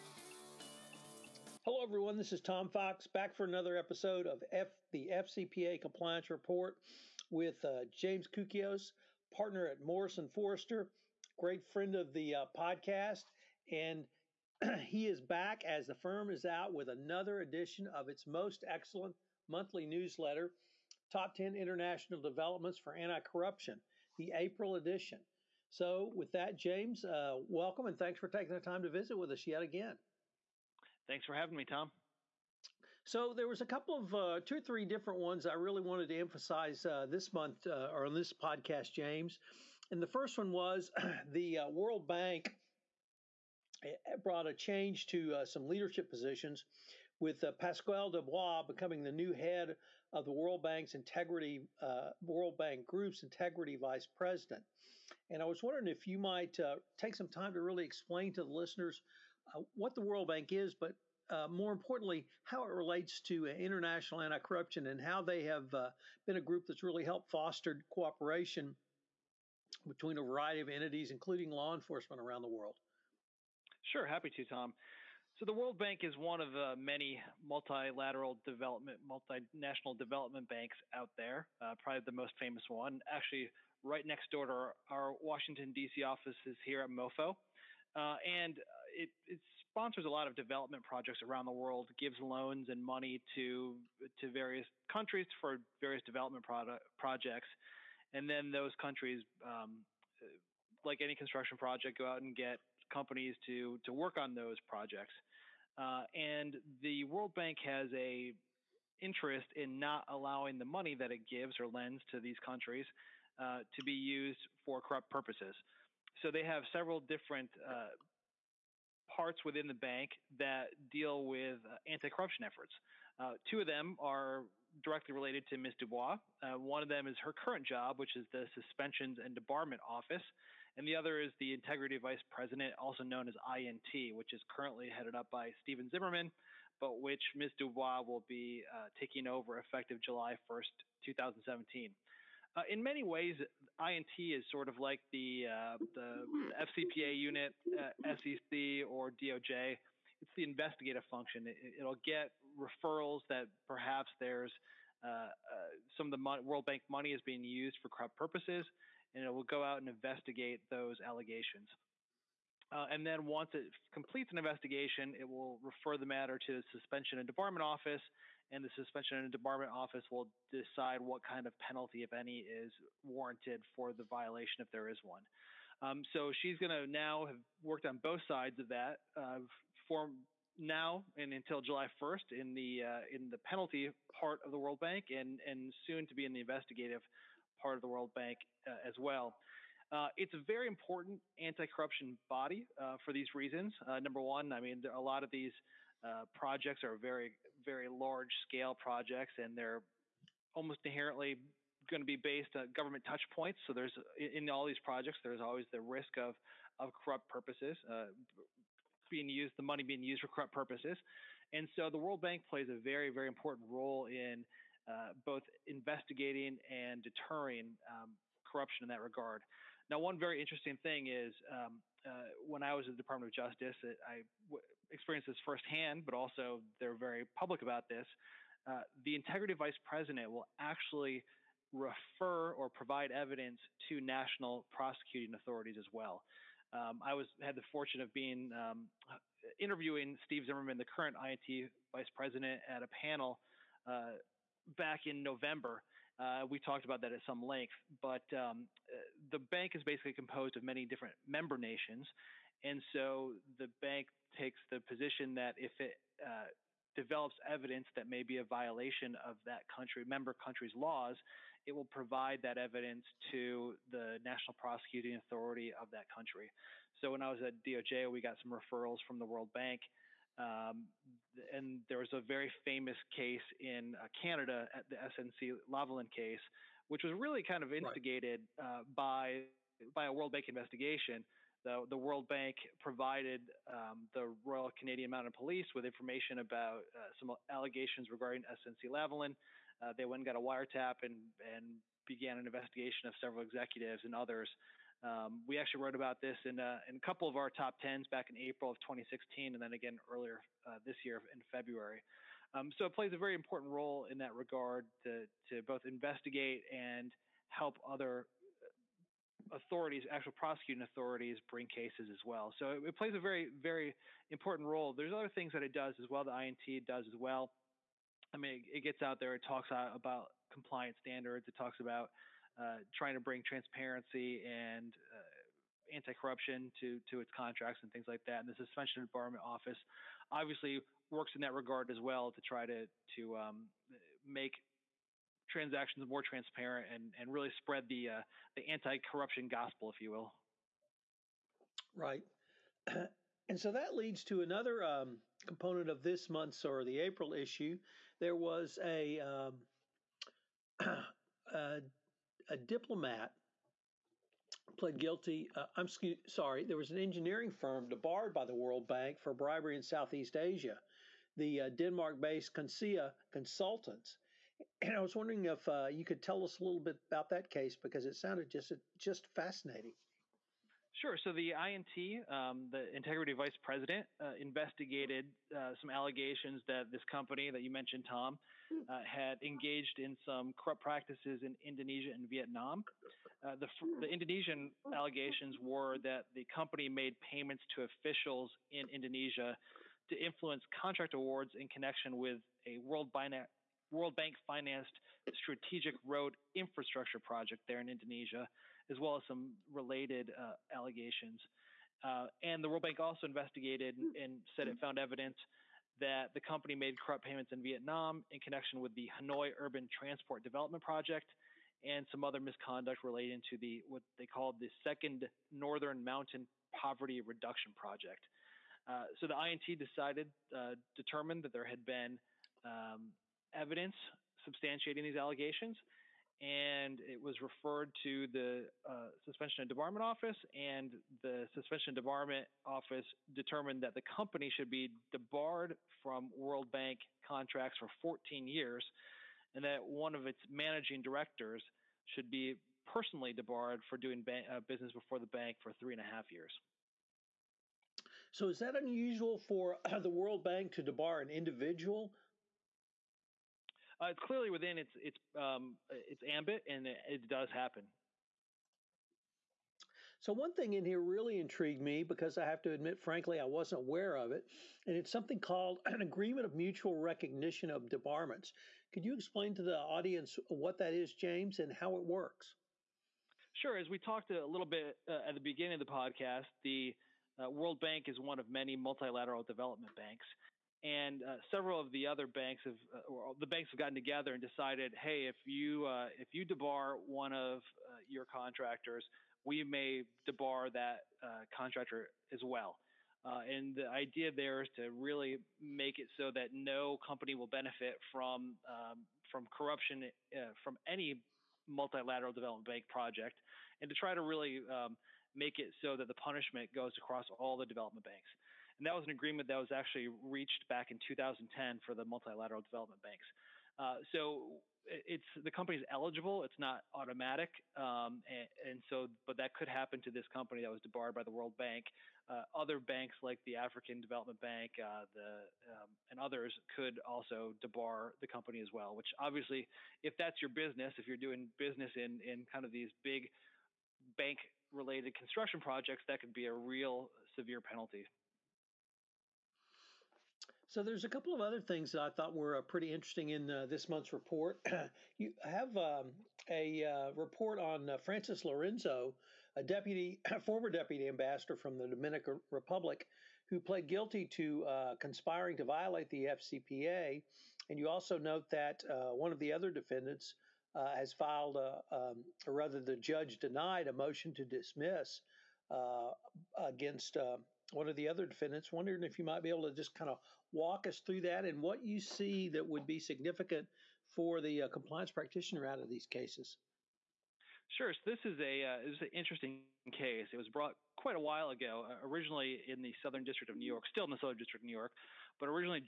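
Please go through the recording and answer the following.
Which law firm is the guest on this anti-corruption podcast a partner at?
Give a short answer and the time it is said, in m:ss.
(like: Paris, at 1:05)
Morrison Forrester, at 0:09.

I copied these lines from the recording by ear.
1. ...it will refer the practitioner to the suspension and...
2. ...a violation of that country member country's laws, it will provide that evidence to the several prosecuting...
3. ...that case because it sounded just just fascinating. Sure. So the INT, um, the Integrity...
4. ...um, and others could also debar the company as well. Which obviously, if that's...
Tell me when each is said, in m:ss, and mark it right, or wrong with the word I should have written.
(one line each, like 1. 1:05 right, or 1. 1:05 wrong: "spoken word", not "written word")
1. 2:45 wrong: "matter", not "practitioner"
2. 4:18 wrong: "national", not "several"
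3. 6:07 right
4. 8:45 right.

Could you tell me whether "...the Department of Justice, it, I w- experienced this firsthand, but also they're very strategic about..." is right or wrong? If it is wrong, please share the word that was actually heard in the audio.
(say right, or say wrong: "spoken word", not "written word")
wrong: "public", not "strategic".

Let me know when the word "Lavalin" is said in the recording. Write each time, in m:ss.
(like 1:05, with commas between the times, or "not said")
4:35, 4:48.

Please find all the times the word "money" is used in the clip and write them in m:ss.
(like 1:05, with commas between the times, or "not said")
1:32, 1:50, 2:36, 3:29.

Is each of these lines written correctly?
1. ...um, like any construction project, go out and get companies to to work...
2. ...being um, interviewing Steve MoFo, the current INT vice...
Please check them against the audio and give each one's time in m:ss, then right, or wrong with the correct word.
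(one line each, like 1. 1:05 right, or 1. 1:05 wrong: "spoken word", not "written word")
1. 1:39 right
2. 3:58 wrong: "Zimmermann", not "MoFo".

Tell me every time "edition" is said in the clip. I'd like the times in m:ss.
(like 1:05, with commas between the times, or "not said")
0:17, 0:24.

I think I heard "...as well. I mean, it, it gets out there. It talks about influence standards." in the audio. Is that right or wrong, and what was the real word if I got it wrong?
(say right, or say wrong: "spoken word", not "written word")
wrong: "compliance", not "influence".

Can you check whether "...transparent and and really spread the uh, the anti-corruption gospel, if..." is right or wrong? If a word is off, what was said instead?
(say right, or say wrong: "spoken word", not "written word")
right.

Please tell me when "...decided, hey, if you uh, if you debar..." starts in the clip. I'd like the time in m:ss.
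8:04.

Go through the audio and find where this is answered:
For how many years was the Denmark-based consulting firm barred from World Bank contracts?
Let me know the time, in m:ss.
7:18.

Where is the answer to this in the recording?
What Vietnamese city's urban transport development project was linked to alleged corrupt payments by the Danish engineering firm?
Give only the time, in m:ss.
6:49.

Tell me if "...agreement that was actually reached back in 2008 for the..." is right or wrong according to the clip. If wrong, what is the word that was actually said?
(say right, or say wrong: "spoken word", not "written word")
wrong: "2010", not "2008".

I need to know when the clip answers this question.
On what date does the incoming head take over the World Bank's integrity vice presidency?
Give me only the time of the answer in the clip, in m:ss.
2:20.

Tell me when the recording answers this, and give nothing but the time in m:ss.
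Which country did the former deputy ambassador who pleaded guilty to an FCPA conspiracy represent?
9:11.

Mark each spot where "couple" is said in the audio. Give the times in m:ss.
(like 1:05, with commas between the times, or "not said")
0:33, 4:57, 9:01.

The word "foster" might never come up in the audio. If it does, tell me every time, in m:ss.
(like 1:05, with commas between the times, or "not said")
1:07.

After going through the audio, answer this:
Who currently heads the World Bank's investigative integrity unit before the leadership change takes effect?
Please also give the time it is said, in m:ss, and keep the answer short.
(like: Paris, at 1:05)
Stephen Zimmermann, at 2:15.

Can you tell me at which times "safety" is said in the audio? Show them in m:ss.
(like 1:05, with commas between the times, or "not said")
not said.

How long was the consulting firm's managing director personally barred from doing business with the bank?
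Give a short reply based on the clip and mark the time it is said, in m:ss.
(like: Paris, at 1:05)
three and a half years, at 7:25.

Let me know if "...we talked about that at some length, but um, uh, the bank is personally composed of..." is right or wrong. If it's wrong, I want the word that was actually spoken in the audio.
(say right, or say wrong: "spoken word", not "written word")
wrong: "basically", not "personally".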